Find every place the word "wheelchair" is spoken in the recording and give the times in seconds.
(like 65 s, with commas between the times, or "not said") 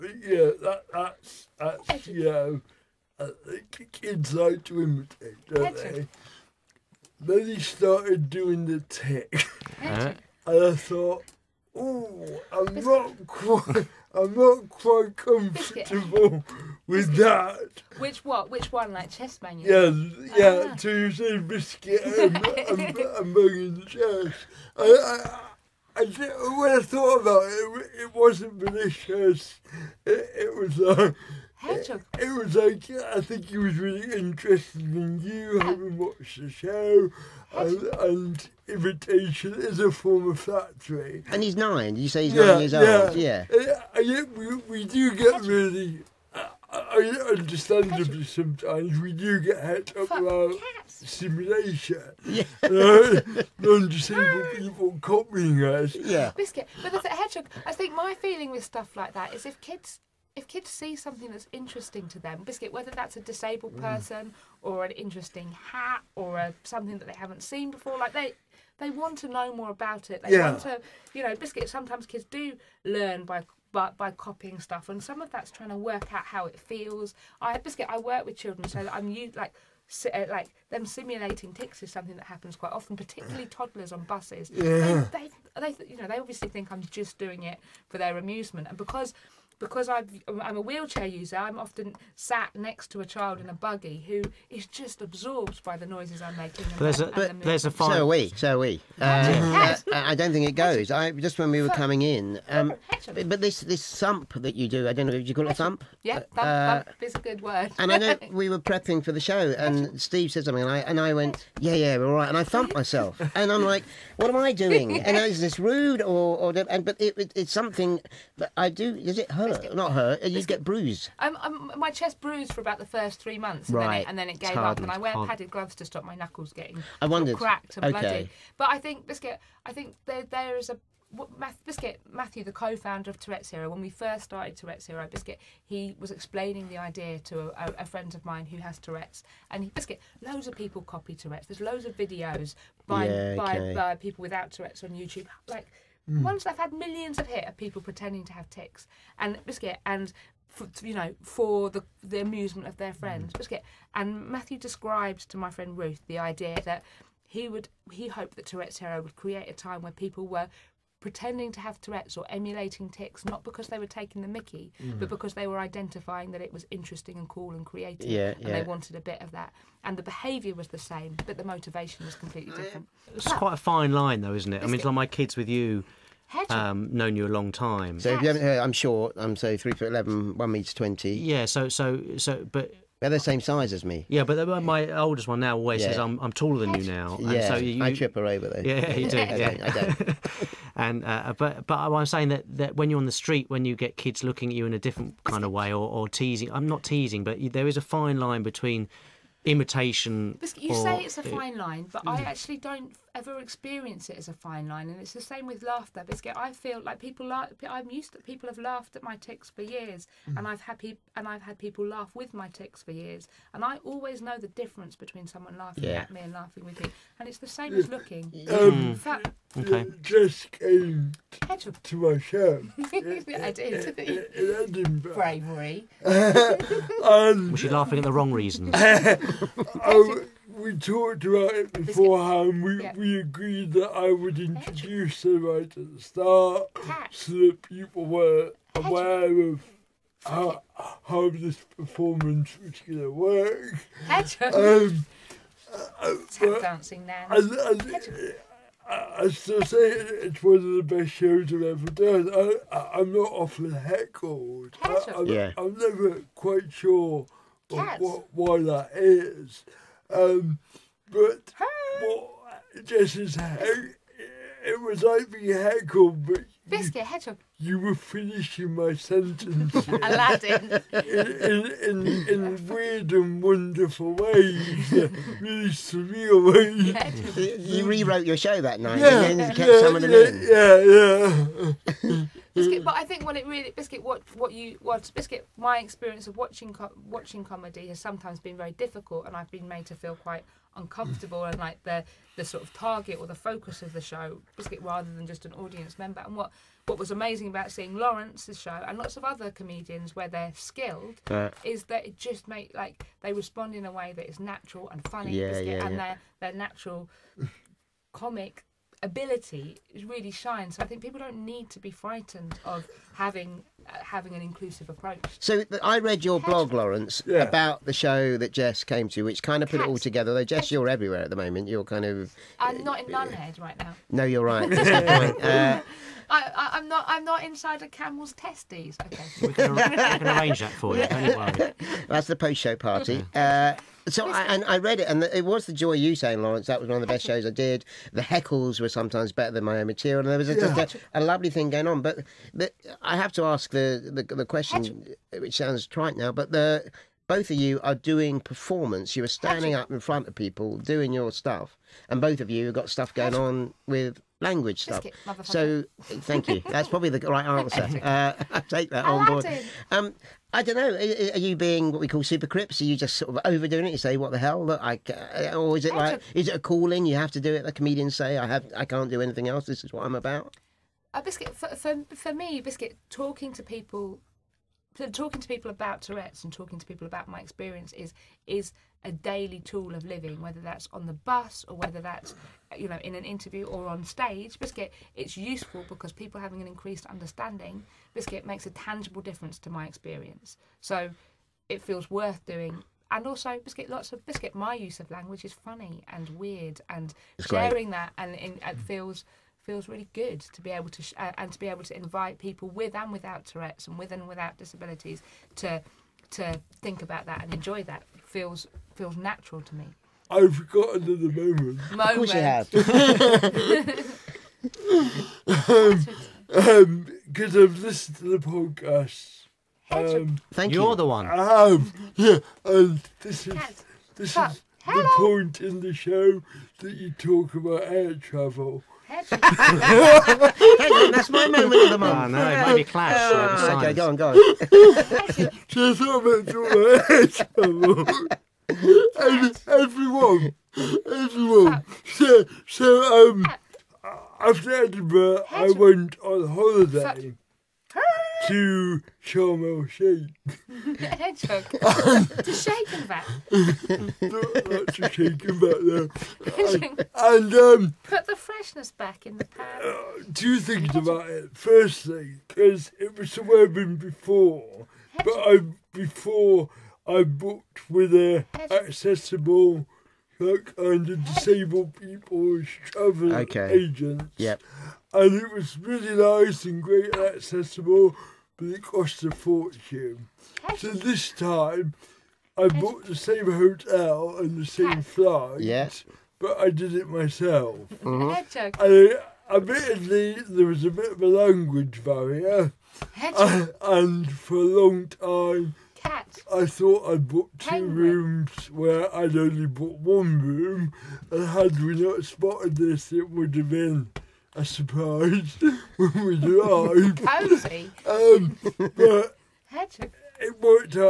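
90 s.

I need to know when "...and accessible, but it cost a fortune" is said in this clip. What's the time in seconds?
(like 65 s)
477 s.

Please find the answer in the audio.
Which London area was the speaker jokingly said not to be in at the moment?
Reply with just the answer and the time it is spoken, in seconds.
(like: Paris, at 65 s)
Nunhead, at 323 s.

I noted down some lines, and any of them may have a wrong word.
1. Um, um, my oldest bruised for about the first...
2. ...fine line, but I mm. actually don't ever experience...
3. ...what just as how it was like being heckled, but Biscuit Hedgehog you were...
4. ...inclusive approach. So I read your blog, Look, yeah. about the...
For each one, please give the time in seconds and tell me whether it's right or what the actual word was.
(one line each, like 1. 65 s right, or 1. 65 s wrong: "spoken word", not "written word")
1. 121 s wrong: "chest", not "oldest"
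2. 201 s right
3. 262 s right
4. 314 s wrong: "Laurence", not "Look".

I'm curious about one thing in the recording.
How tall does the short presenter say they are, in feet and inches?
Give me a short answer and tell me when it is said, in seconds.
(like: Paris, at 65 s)
3 foot 11, at 179 s.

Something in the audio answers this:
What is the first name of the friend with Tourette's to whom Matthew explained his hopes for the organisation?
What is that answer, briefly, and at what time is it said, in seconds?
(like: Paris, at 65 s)
Ruth, at 155 s.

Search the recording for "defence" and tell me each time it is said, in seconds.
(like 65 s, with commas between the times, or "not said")
not said.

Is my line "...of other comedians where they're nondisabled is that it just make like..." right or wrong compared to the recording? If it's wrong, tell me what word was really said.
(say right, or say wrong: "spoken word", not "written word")
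wrong: "skilled", not "nondisabled".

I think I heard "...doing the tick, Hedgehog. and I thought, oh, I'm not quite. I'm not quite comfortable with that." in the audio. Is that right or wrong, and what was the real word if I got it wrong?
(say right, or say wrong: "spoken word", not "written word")
right.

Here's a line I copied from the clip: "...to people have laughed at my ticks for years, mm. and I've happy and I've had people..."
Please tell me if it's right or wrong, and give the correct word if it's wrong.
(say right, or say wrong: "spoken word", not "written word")
right.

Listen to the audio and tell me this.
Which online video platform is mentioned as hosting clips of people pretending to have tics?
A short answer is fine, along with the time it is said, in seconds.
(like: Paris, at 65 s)
YouTube, at 144 s.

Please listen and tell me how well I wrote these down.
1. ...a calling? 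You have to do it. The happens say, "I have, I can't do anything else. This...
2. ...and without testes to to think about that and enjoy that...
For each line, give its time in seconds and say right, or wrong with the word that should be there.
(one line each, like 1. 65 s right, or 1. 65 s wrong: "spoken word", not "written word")
1. 366 s wrong: "comedians", not "happens"
2. 404 s wrong: "disabilities", not "testes".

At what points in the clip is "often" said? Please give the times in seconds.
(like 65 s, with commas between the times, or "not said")
82 s, 91 s, 253 s.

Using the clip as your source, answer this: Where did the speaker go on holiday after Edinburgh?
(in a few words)
Sharm el Sheikh.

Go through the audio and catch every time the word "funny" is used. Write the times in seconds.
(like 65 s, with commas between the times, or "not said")
305 s, 395 s.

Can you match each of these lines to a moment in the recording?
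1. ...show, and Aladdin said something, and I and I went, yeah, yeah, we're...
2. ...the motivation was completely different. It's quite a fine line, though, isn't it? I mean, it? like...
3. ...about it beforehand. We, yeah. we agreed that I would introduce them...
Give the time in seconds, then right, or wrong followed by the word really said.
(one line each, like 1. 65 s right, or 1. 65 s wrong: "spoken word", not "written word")
1. 109 s wrong: "Steve", not "Aladdin"
2. 171 s right
3. 231 s right.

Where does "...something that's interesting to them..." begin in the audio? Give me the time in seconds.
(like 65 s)
60 s.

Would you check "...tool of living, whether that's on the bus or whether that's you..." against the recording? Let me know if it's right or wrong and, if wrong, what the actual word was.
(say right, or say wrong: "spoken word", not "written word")
right.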